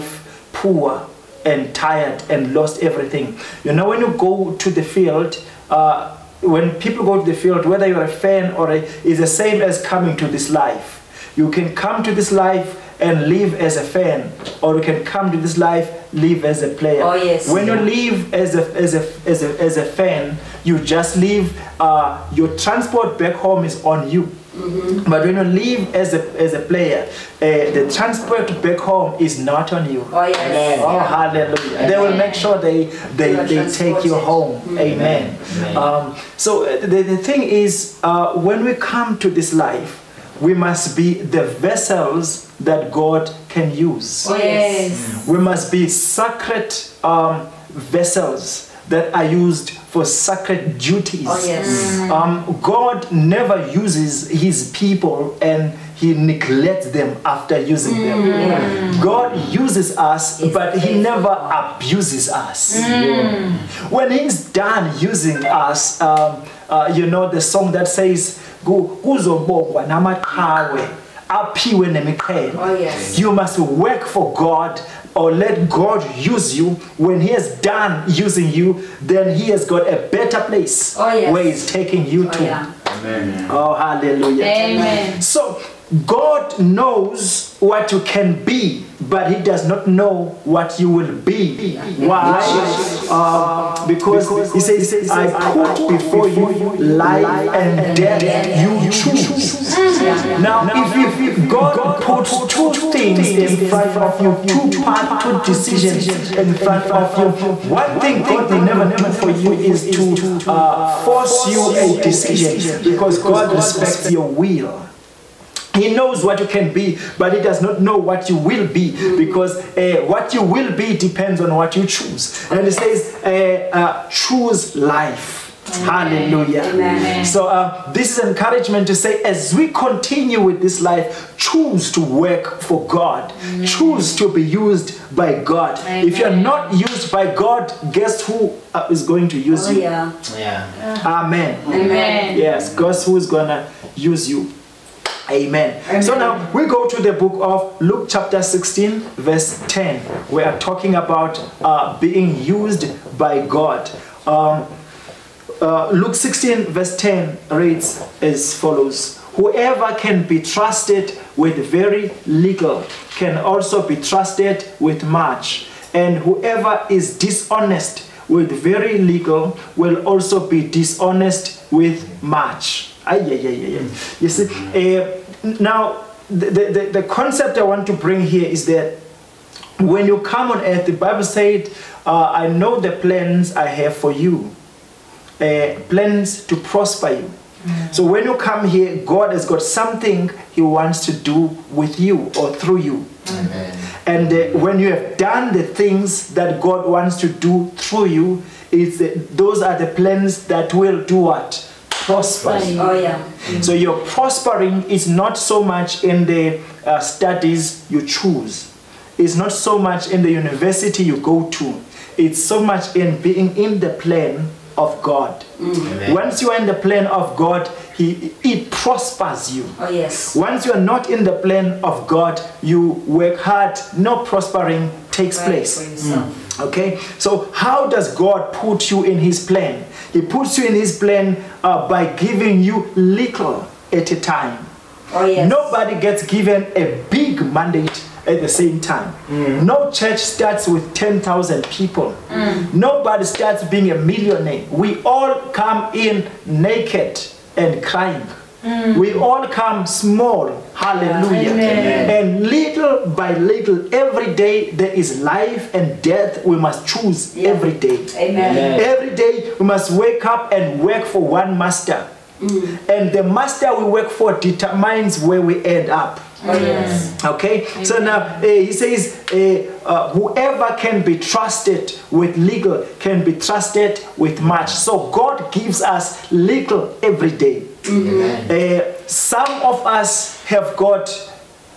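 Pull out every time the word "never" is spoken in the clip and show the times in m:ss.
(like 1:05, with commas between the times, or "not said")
0:53, 1:01, 1:48.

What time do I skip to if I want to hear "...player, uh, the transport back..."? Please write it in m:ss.
0:26.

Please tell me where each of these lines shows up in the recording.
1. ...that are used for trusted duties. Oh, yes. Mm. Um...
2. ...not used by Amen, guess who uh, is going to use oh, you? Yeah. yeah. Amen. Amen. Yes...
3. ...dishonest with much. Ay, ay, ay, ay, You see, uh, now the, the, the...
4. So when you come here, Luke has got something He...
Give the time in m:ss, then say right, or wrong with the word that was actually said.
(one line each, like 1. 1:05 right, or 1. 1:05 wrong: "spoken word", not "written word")
1. 0:48 wrong: "sacred", not "trusted"
2. 2:16 wrong: "God", not "Amen"
3. 2:50 right
4. 3:07 wrong: "God", not "Luke".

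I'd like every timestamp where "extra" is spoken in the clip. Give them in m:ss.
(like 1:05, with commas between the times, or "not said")
not said.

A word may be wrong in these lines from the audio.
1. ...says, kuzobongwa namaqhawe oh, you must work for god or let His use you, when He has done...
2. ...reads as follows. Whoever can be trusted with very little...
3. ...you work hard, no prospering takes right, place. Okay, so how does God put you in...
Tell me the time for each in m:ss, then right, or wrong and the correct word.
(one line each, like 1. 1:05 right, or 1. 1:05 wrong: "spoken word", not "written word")
1. 1:07 wrong: "God", not "His"
2. 2:37 right
3. 3:42 right.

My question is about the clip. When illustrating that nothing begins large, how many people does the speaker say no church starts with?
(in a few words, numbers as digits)
10,000.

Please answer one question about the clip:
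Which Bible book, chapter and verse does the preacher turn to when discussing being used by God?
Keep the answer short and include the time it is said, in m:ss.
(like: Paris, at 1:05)
Luke 16:10, at 2:27.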